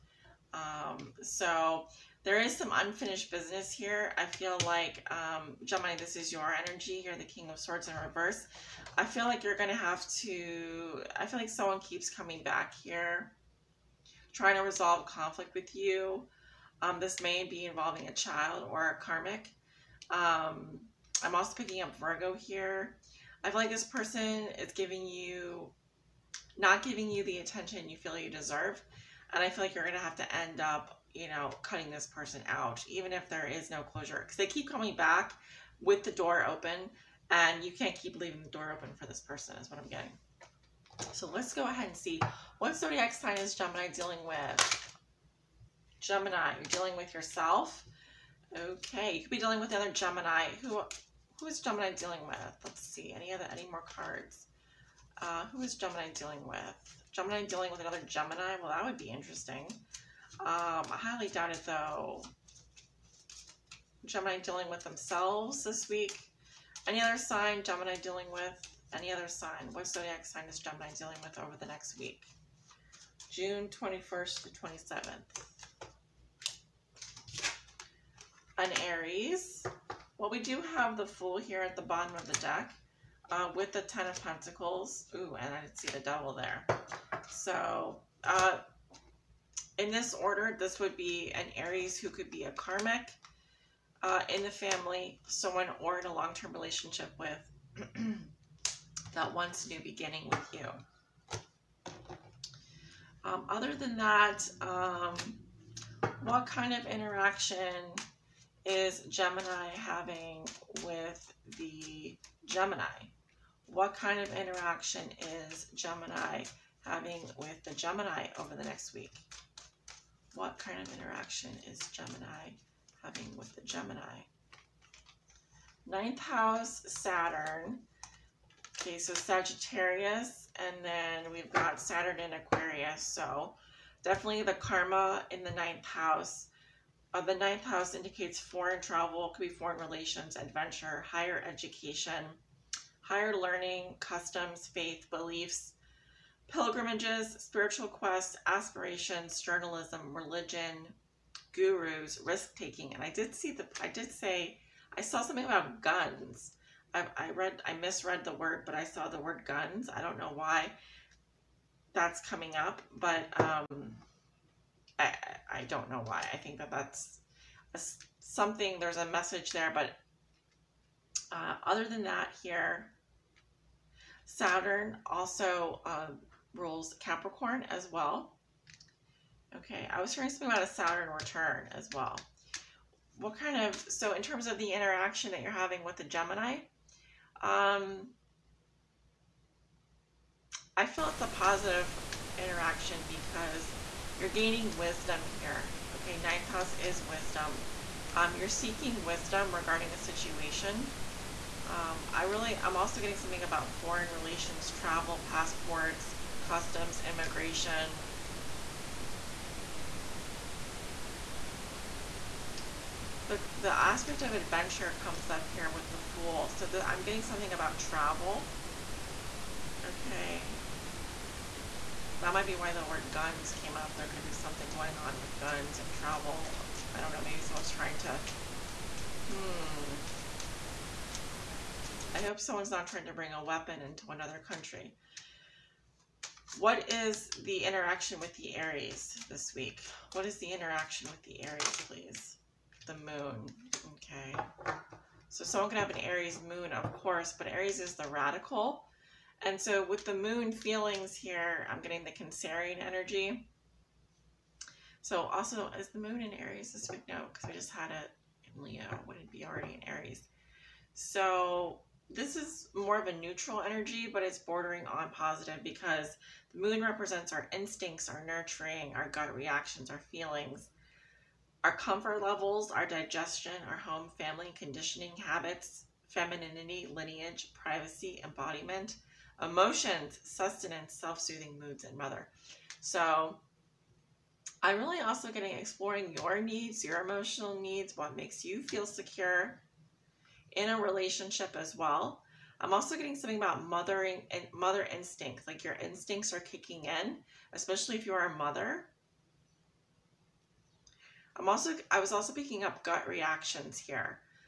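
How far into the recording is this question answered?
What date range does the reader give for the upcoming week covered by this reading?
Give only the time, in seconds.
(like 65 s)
73 s.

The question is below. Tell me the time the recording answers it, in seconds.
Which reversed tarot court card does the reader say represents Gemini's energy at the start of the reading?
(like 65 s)
7 s.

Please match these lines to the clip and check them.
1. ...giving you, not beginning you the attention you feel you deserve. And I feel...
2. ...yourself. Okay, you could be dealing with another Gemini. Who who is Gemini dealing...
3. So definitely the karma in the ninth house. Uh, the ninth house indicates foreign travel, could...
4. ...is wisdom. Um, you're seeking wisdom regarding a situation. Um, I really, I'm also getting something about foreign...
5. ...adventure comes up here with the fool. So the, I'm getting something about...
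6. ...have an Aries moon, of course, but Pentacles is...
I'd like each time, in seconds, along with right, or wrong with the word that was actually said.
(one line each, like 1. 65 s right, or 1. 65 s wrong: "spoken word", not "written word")
1. 24 s wrong: "giving", not "beginning"
2. 47 s right
3. 133 s right
4. 196 s right
5. 214 s right
6. 245 s wrong: "Aries", not "Pentacles".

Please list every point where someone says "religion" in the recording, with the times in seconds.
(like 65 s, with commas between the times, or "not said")
150 s.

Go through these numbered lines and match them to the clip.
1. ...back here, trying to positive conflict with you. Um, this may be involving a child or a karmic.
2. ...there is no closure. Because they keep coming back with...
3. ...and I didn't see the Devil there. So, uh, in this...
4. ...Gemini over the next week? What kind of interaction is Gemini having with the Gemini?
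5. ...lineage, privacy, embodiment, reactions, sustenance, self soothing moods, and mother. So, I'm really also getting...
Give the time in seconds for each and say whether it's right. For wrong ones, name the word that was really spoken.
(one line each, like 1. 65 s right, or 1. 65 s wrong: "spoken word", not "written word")
1. 12 s wrong: "resolve", not "positive"
2. 33 s right
3. 85 s right
4. 117 s right
5. 276 s wrong: "emotions", not "reactions".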